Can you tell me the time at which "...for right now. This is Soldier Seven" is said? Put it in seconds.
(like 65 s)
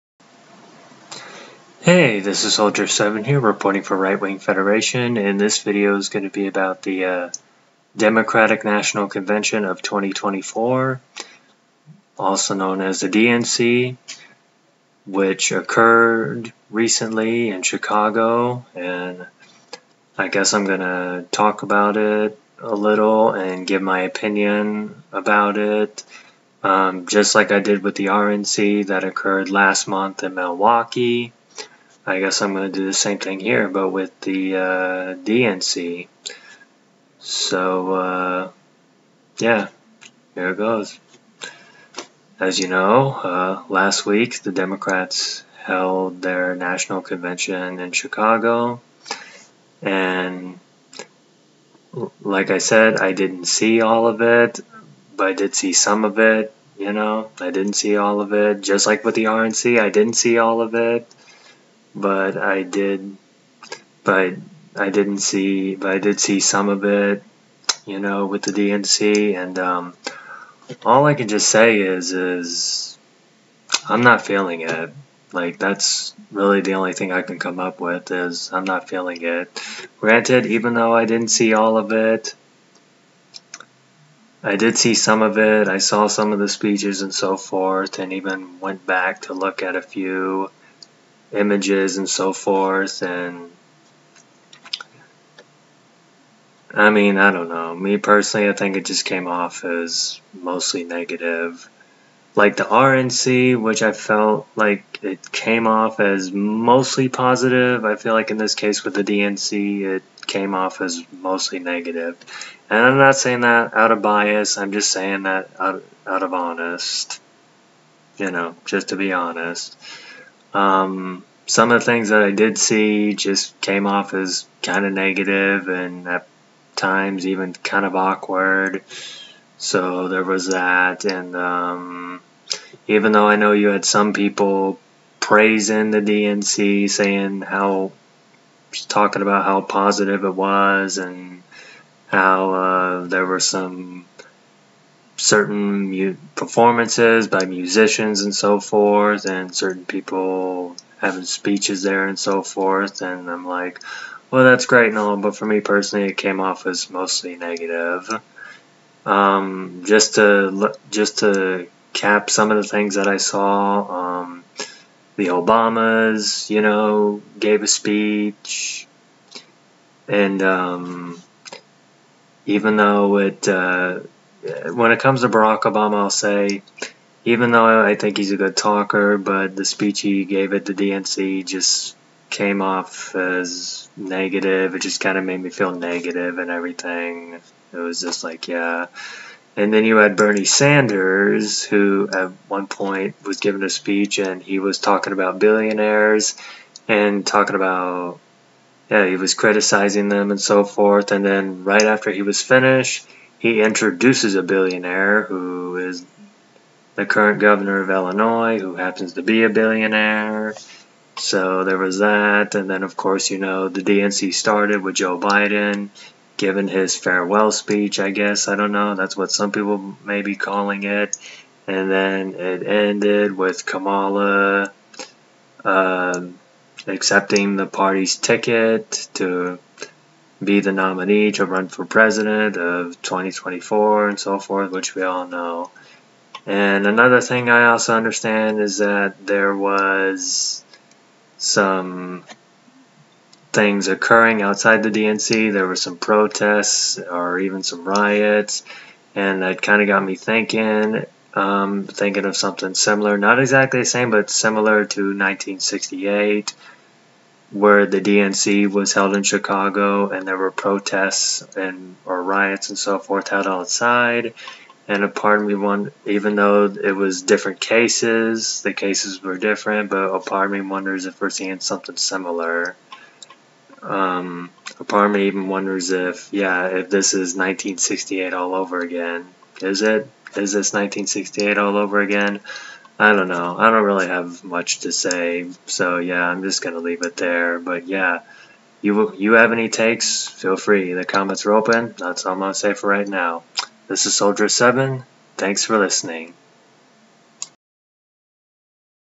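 292 s.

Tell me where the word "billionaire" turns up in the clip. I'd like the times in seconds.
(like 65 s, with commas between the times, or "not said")
195 s, 204 s, 209 s.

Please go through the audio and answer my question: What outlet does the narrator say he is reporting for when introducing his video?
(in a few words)
Right Wing Federation.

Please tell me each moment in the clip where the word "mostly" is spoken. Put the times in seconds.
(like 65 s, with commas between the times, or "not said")
100 s, 106 s, 111 s, 156 s.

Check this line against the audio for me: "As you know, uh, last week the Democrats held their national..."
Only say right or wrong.
right.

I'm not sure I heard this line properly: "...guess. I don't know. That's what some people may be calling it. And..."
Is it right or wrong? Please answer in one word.
right.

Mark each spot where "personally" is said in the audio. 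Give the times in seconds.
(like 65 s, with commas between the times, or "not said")
97 s, 155 s.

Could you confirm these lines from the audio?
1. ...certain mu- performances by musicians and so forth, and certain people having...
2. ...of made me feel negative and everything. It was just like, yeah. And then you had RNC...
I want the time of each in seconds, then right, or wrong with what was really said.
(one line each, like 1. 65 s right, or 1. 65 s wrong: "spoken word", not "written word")
1. 145 s right
2. 185 s wrong: "Bernie", not "RNC".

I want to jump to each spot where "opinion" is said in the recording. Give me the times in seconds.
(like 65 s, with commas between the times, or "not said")
24 s.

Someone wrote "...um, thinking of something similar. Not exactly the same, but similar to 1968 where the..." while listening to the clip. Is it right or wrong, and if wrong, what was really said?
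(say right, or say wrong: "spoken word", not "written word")
right.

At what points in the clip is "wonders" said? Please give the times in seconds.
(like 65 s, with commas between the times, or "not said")
270 s, 275 s.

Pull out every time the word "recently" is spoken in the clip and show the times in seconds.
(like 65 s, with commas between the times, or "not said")
16 s.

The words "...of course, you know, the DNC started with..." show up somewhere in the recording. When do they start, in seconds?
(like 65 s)
212 s.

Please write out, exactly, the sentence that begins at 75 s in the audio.
Like that's really the only thing I can come up with is I'm not feeling it.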